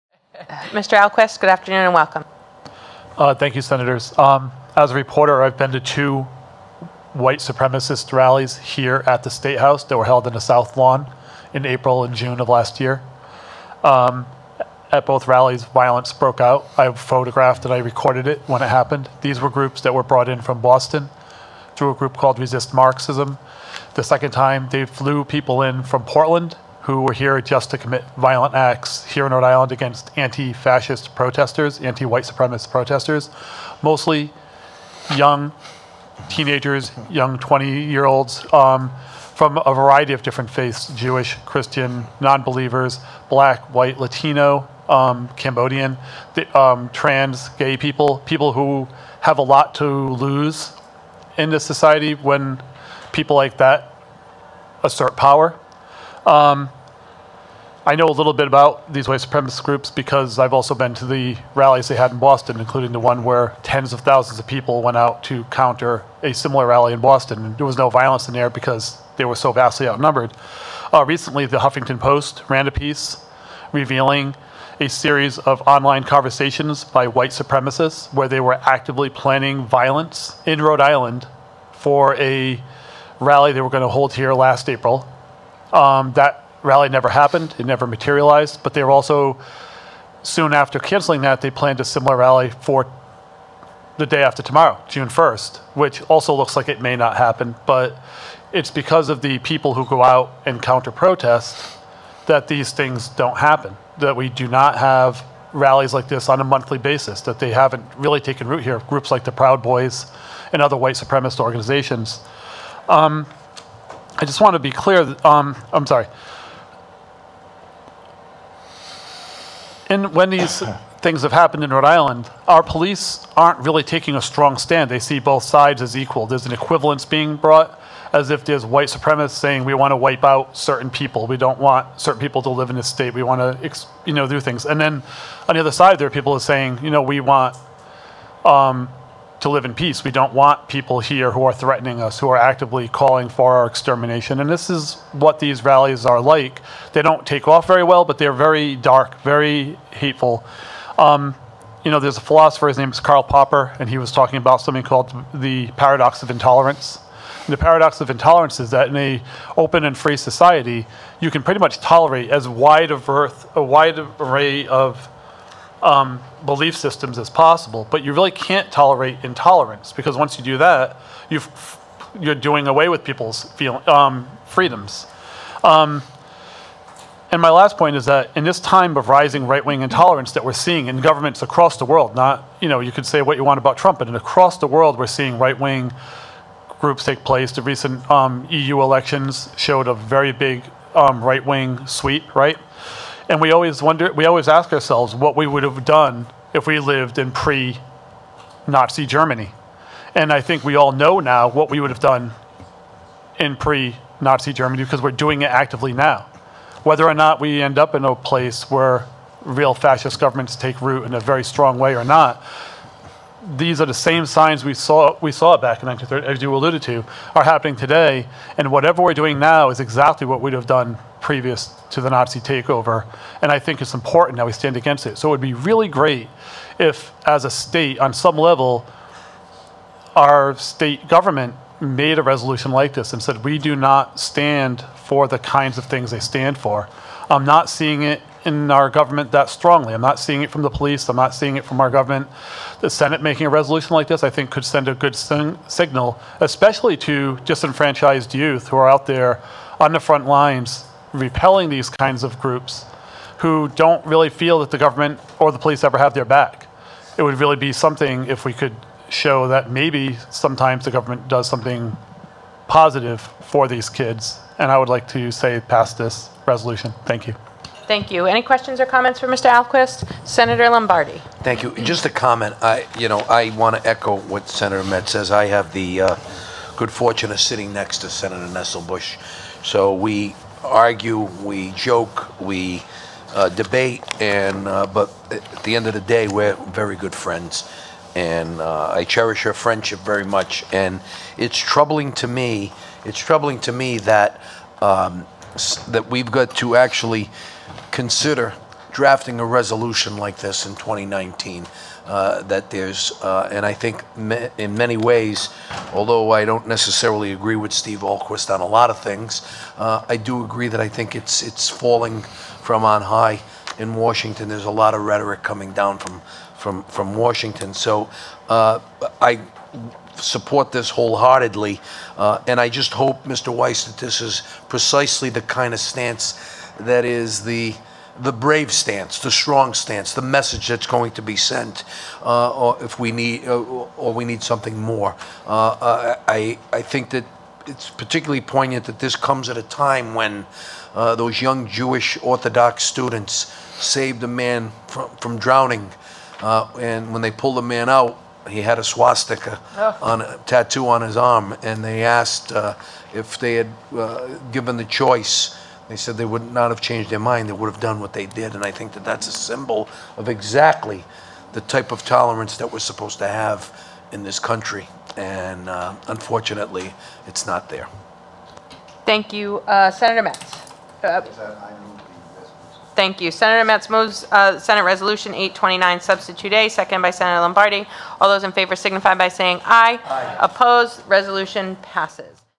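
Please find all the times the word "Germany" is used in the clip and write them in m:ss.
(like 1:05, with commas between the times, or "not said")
3:19, 3:24.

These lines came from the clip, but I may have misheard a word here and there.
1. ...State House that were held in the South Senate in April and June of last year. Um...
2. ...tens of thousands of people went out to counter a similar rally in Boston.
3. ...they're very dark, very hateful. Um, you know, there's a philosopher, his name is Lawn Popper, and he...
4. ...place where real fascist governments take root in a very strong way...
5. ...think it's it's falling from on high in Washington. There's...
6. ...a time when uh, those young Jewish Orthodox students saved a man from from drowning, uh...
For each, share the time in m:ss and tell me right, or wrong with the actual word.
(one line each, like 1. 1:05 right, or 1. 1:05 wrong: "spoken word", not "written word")
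1. 0:09 wrong: "Lawn", not "Senate"
2. 1:03 right
3. 2:28 wrong: "Karl", not "Lawn"
4. 3:28 right
5. 5:10 right
6. 5:39 right.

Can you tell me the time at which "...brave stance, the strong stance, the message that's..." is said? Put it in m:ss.
5:28.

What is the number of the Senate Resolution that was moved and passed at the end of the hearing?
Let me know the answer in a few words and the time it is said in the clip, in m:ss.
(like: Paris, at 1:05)
829, at 6:15.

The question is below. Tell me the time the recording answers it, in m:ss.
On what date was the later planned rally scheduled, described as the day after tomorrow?
1:34.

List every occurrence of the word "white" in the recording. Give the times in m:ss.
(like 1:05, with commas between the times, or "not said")
0:07, 0:32, 0:43, 0:59, 1:17, 1:50, 2:08.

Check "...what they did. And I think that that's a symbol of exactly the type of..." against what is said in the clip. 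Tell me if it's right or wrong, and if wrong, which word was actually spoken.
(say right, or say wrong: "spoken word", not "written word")
right.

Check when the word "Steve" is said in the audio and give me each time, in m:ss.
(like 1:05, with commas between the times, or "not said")
5:07.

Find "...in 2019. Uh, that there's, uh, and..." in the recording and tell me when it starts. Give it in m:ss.
5:00.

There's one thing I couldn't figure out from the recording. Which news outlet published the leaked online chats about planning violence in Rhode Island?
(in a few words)
Huffington Post.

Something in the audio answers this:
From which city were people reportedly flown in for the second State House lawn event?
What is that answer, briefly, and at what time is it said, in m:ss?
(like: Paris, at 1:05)
Portland, at 0:26.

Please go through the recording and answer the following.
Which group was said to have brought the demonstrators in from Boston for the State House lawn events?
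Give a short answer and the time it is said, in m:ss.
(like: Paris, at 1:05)
Resist Marxism, at 0:22.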